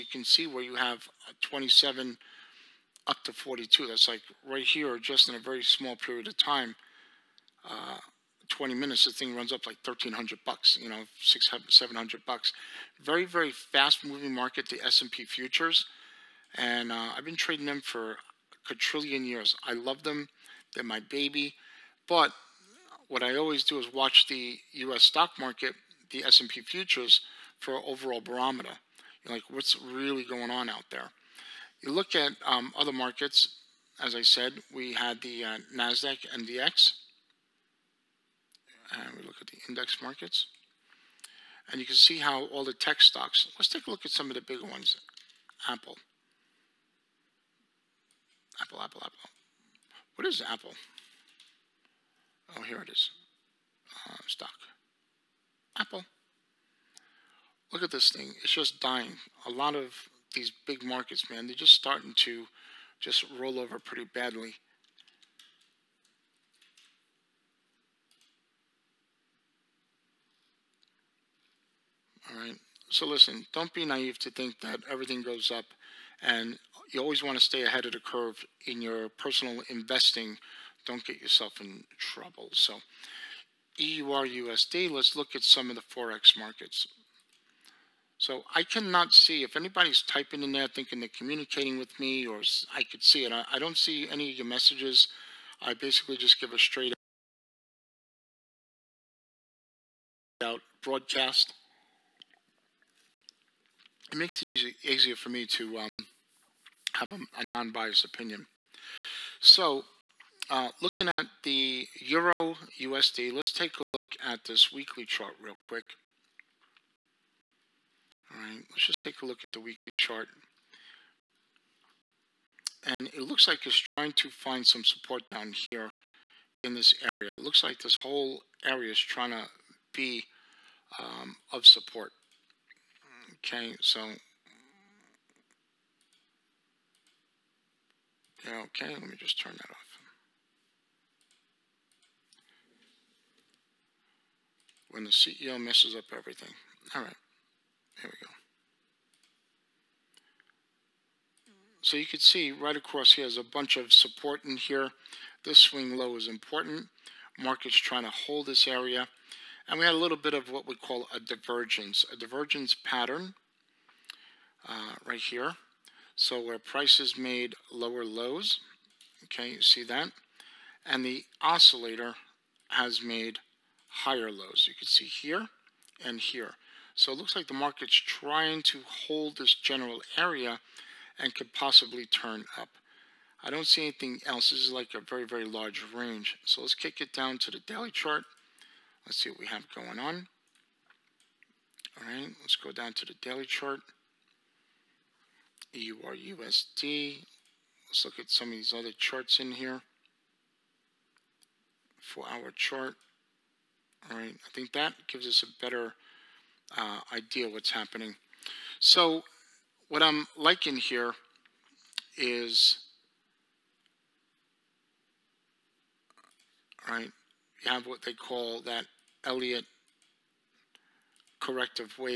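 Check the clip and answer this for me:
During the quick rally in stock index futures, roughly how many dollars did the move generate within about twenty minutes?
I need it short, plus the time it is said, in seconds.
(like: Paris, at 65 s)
1300, at 9 s.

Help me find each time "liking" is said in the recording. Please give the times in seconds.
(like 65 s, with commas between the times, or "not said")
210 s.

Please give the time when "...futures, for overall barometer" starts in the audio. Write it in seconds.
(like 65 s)
26 s.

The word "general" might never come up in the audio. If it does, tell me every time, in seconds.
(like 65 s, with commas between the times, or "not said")
179 s.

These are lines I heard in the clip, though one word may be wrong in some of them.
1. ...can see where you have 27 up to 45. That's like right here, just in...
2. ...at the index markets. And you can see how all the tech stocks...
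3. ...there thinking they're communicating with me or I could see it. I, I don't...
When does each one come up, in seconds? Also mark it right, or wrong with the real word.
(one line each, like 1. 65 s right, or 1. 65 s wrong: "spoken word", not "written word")
1. 0 s wrong: "42", not "45"
2. 39 s right
3. 90 s right.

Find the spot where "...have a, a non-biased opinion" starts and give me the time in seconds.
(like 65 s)
106 s.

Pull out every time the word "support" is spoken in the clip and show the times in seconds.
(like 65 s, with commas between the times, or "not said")
124 s, 131 s, 153 s.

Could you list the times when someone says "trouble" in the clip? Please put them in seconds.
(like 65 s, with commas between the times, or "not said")
81 s.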